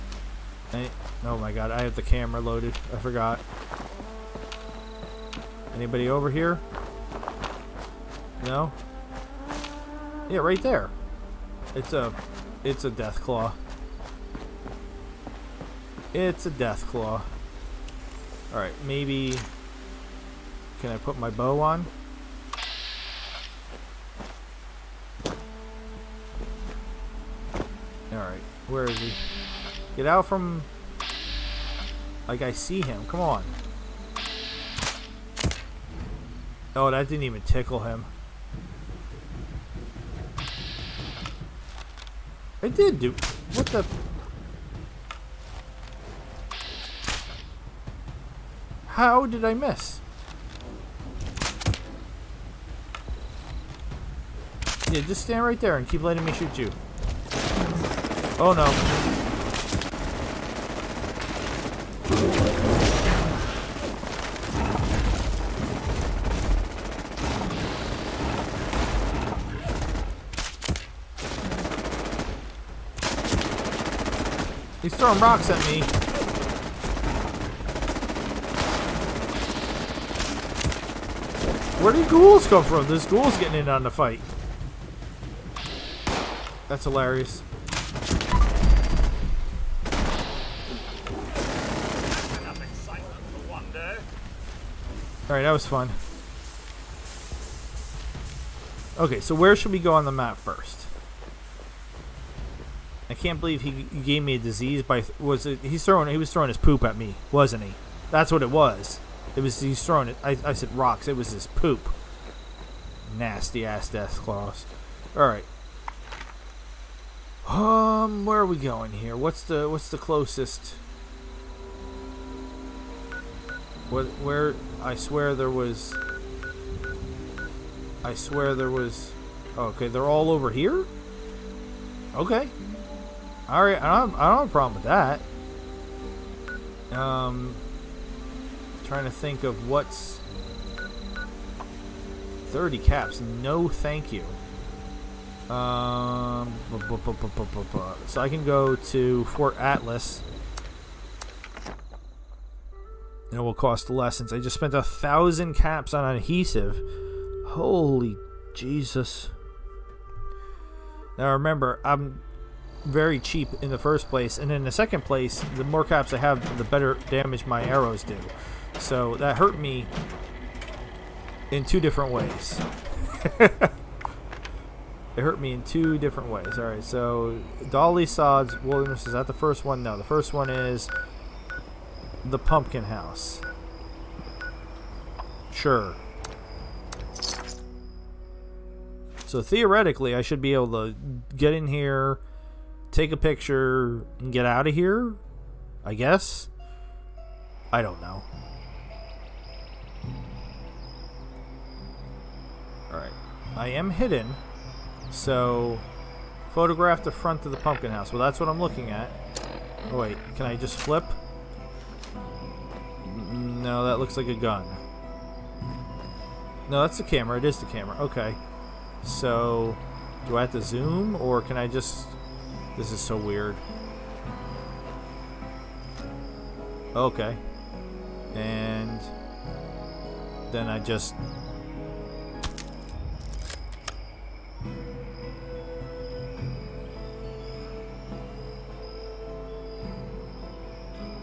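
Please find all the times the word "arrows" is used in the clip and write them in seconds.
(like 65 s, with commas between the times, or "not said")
167 s.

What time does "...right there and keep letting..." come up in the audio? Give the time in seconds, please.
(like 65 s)
55 s.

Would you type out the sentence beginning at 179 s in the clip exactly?
No, the first one is the Pumpkin House.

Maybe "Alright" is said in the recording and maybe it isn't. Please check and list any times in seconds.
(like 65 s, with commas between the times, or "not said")
18 s, 28 s, 95 s, 176 s, 202 s.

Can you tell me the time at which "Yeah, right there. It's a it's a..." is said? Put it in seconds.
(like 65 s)
10 s.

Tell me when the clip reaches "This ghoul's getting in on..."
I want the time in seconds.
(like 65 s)
82 s.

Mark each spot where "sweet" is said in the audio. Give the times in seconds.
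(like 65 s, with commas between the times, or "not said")
not said.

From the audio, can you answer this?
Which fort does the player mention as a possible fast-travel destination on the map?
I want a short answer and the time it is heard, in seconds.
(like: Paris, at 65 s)
Fort Atlas, at 149 s.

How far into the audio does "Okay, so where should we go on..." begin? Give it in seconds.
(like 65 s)
98 s.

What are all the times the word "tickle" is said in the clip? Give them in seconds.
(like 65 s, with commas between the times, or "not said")
37 s.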